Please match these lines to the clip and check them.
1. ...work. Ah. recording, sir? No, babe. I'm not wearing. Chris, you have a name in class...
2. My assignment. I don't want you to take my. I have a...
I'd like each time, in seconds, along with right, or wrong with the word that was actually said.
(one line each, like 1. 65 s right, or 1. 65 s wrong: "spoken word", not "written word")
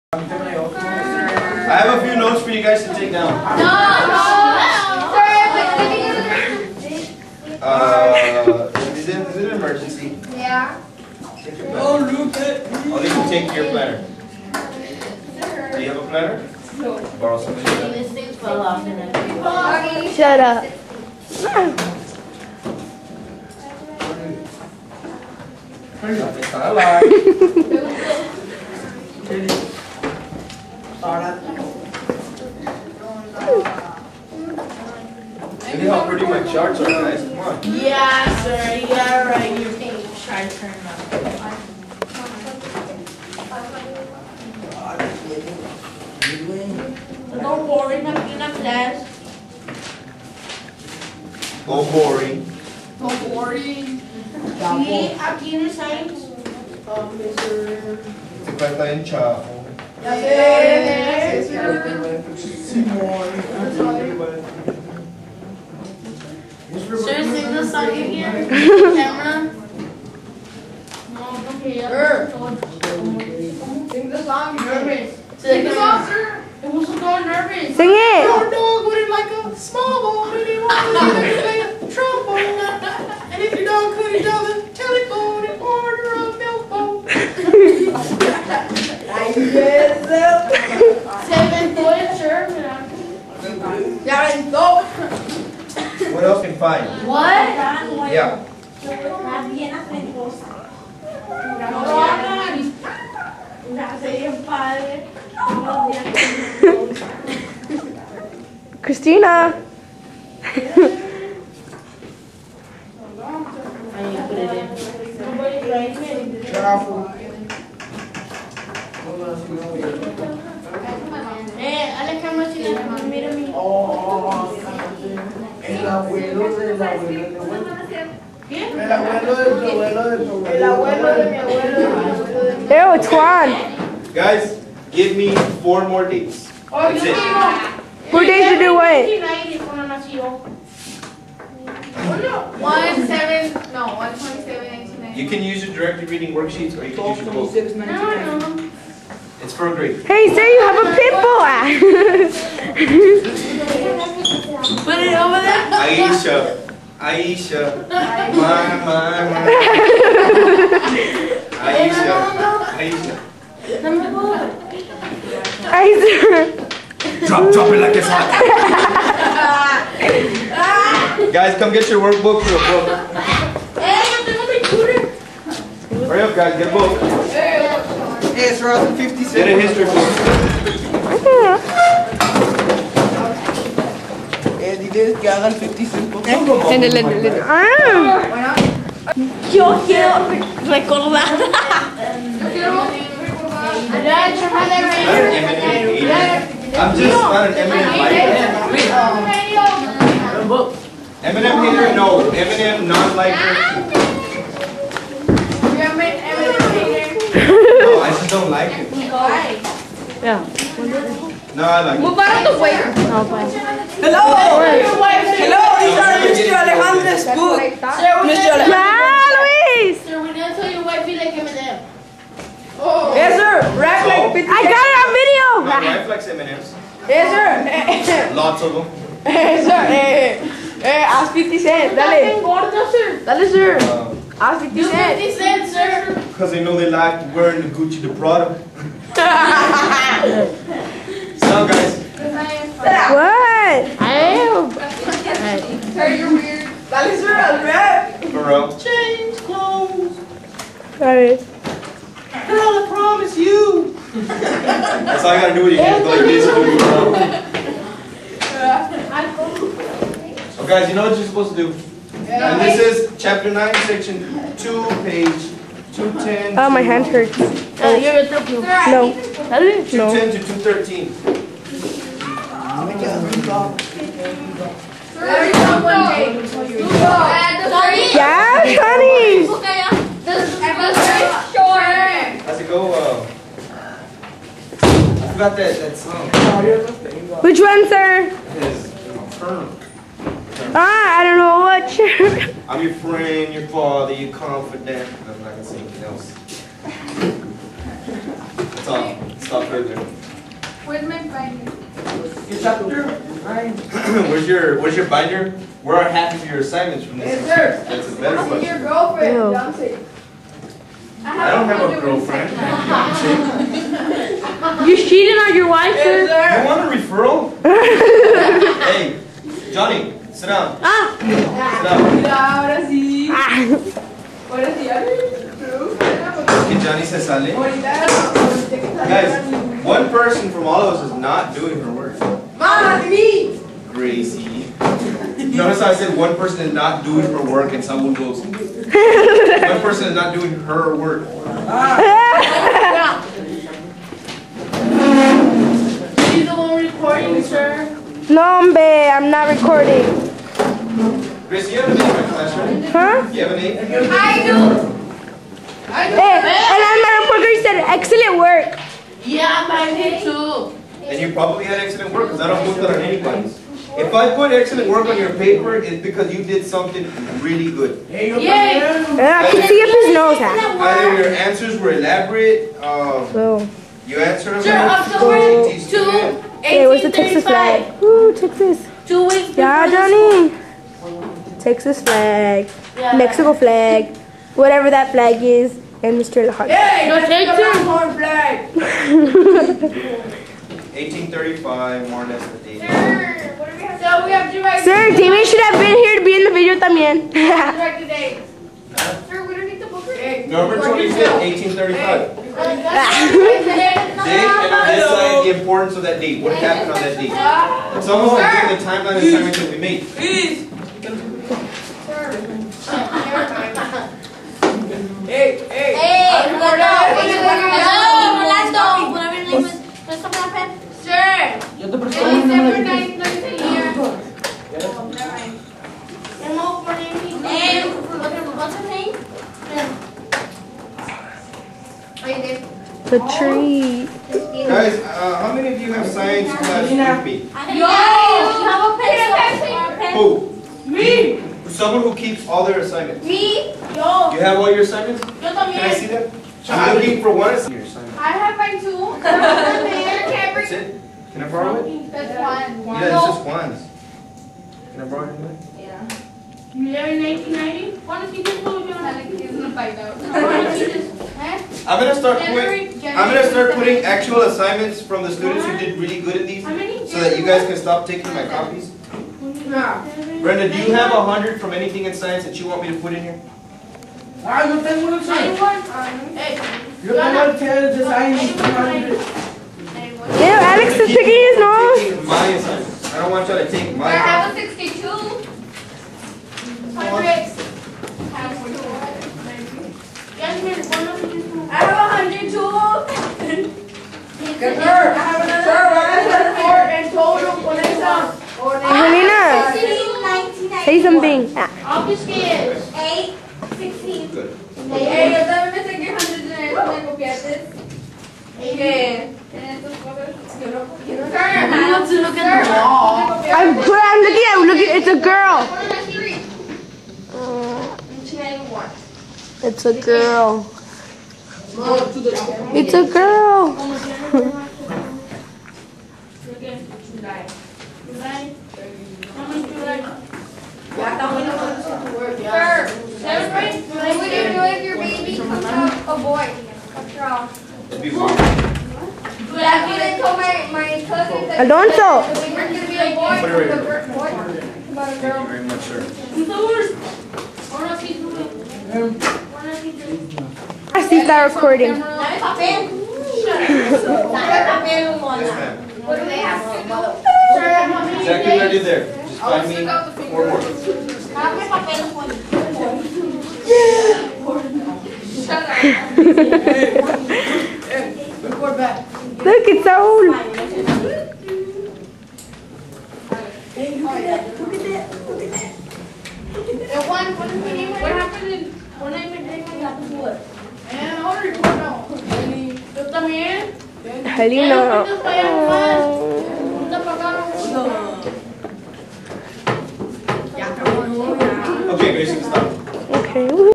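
1. 340 s wrong: "recording", not "wearing"
2. 482 s right.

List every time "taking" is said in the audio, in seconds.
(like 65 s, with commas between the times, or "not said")
468 s, 481 s.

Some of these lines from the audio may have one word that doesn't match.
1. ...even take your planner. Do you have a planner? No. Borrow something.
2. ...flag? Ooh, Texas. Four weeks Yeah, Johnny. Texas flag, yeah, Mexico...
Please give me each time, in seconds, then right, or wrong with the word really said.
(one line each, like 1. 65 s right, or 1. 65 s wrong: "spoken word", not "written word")
1. 15 s right
2. 377 s wrong: "Two", not "Four".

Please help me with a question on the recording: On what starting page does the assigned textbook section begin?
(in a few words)
210.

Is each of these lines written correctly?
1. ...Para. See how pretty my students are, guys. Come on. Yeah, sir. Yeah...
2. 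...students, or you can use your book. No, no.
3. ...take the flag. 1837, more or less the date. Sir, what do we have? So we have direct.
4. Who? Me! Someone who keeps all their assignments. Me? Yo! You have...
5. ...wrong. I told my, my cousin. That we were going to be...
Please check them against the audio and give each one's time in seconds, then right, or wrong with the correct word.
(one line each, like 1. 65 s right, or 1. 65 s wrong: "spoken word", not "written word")
1. 31 s wrong: "charts", not "students"
2. 146 s wrong: "worksheets", not "students"
3. 387 s wrong: "1835", not "1837"
4. 440 s right
5. 538 s right.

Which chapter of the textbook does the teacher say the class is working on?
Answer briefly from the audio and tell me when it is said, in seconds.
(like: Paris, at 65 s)
Chapter 9, at 263 s.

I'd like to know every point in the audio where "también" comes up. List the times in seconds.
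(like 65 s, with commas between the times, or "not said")
396 s, 445 s.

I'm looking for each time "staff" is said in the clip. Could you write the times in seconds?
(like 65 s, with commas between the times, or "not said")
not said.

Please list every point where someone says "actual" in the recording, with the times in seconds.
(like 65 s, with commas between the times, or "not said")
464 s.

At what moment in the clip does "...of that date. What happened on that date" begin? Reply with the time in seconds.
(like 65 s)
405 s.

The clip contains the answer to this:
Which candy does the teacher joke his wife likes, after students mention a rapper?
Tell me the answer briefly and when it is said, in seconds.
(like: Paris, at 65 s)
M&M's, at 226 s.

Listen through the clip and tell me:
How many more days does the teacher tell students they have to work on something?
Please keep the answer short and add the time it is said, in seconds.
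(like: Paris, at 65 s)
4, at 135 s.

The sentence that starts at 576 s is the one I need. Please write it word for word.
And one, one, what happened in, when I met him, what happened to what?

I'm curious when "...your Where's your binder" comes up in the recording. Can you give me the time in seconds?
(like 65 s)
304 s.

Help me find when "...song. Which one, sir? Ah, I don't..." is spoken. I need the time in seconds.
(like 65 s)
285 s.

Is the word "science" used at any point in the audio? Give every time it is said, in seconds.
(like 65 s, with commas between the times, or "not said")
55 s, 436 s, 472 s, 478 s.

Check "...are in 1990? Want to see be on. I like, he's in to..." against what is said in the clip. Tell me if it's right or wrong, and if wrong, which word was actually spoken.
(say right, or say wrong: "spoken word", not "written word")
right.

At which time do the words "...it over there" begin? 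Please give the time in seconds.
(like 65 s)
154 s.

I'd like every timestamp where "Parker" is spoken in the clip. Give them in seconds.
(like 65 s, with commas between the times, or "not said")
357 s.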